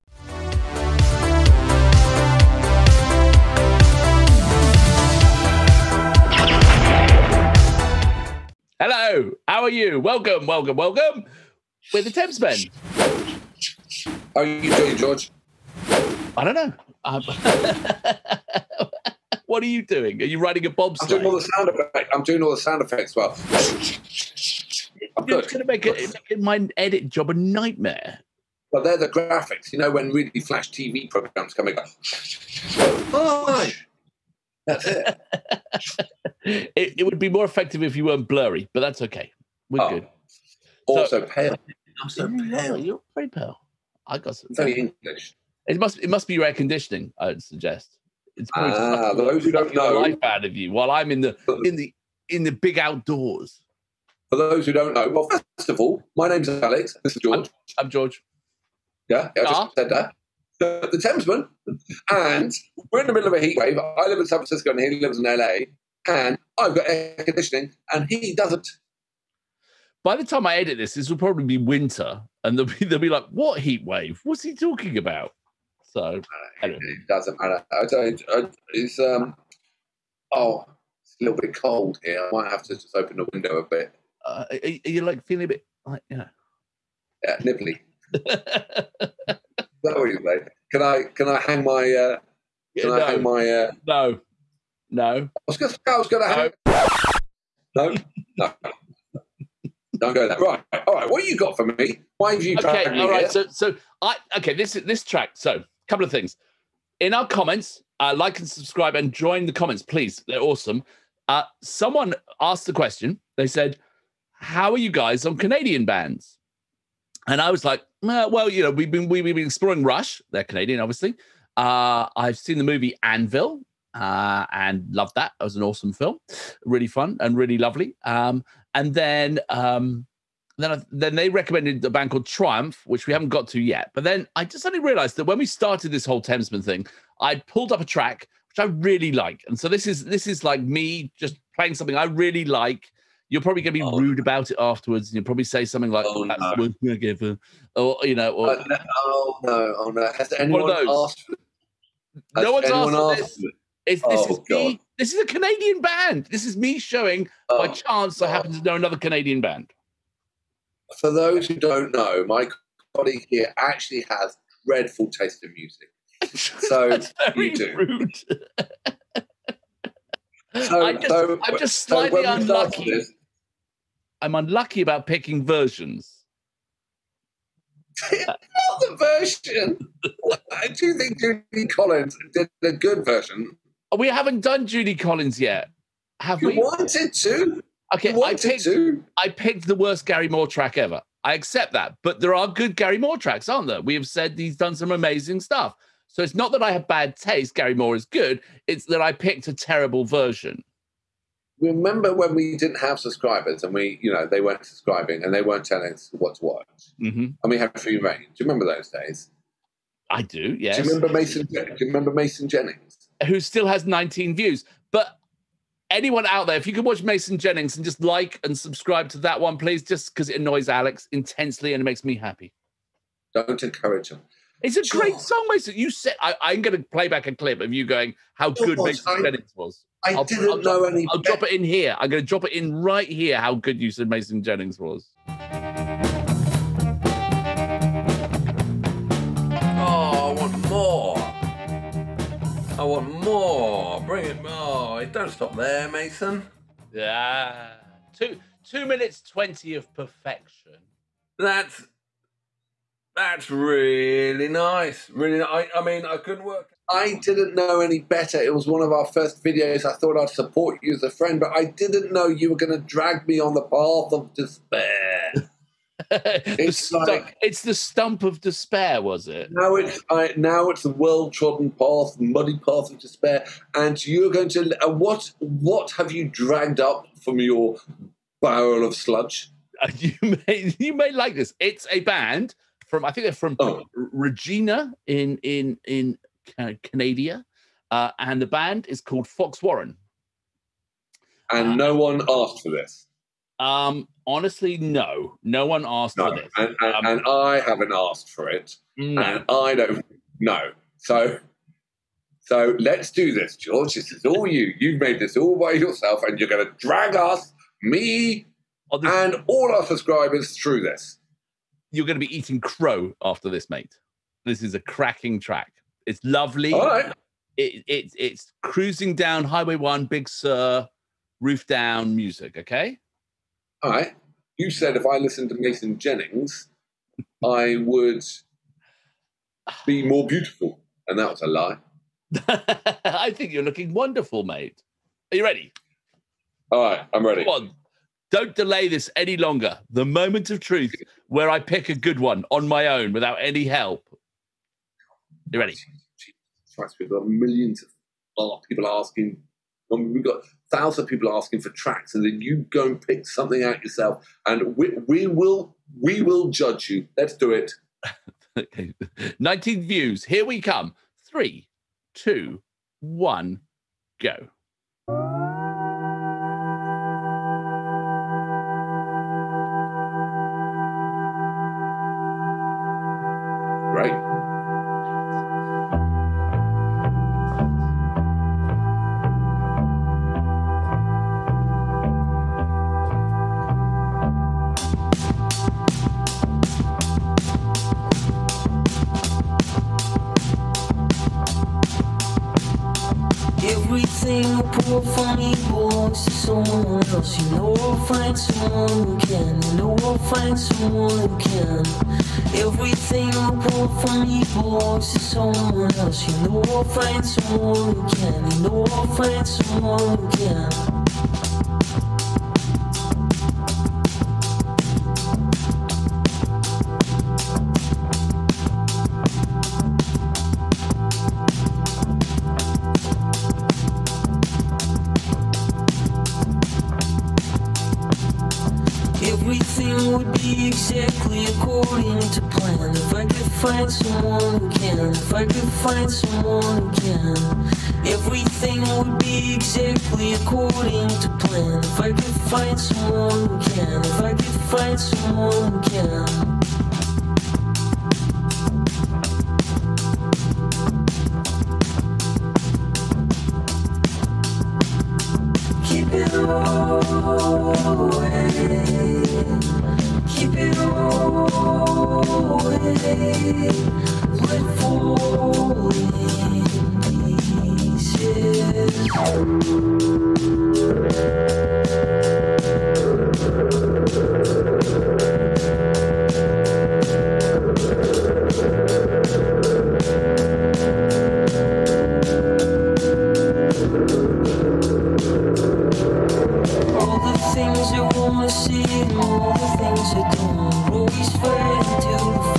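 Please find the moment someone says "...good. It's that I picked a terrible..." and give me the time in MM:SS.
03:18.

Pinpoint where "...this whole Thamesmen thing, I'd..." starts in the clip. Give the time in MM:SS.
02:15.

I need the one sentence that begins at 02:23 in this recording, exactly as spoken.
You're probably going to be oh.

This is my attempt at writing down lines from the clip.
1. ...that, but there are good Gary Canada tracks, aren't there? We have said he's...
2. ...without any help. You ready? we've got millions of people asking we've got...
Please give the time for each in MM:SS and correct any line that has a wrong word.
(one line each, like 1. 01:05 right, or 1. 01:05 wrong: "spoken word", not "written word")
1. 03:11 wrong: "Moore", not "Canada"
2. 05:43 right.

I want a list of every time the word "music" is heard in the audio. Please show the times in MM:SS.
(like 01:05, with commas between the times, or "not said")
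02:45, 05:22.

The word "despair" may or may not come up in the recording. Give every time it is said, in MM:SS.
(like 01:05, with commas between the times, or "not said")
04:24, 04:28, 04:32.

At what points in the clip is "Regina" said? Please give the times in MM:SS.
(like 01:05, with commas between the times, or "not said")
04:43.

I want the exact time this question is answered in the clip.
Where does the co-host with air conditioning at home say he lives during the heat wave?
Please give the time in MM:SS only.
01:04.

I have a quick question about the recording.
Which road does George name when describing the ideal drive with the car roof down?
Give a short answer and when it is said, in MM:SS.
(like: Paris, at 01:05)
Highway One, at 05:19.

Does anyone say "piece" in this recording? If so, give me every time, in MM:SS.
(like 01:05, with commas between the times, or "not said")
not said.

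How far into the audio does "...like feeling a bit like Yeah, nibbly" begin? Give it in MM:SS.
01:25.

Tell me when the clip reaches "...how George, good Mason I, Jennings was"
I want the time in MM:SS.
03:48.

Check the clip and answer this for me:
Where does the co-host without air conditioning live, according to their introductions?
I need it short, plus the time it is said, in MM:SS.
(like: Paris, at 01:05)
LA, at 01:05.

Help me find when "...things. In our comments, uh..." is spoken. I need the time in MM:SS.
01:46.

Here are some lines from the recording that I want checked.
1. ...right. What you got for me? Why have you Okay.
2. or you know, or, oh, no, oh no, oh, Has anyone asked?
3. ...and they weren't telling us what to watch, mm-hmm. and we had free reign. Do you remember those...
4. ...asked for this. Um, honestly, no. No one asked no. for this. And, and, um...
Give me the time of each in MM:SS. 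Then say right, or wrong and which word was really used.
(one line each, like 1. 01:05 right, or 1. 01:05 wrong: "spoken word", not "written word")
1. 01:40 right
2. 02:27 right
3. 03:25 right
4. 04:52 right.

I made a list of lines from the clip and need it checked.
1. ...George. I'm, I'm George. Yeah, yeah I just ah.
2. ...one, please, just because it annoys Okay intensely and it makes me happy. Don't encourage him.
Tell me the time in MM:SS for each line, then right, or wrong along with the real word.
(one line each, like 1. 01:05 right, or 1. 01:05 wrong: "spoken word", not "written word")
1. 00:57 right
2. 03:39 wrong: "Alex", not "Okay".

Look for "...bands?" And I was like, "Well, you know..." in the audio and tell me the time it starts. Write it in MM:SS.
01:55.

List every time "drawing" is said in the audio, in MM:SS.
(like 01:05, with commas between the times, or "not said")
not said.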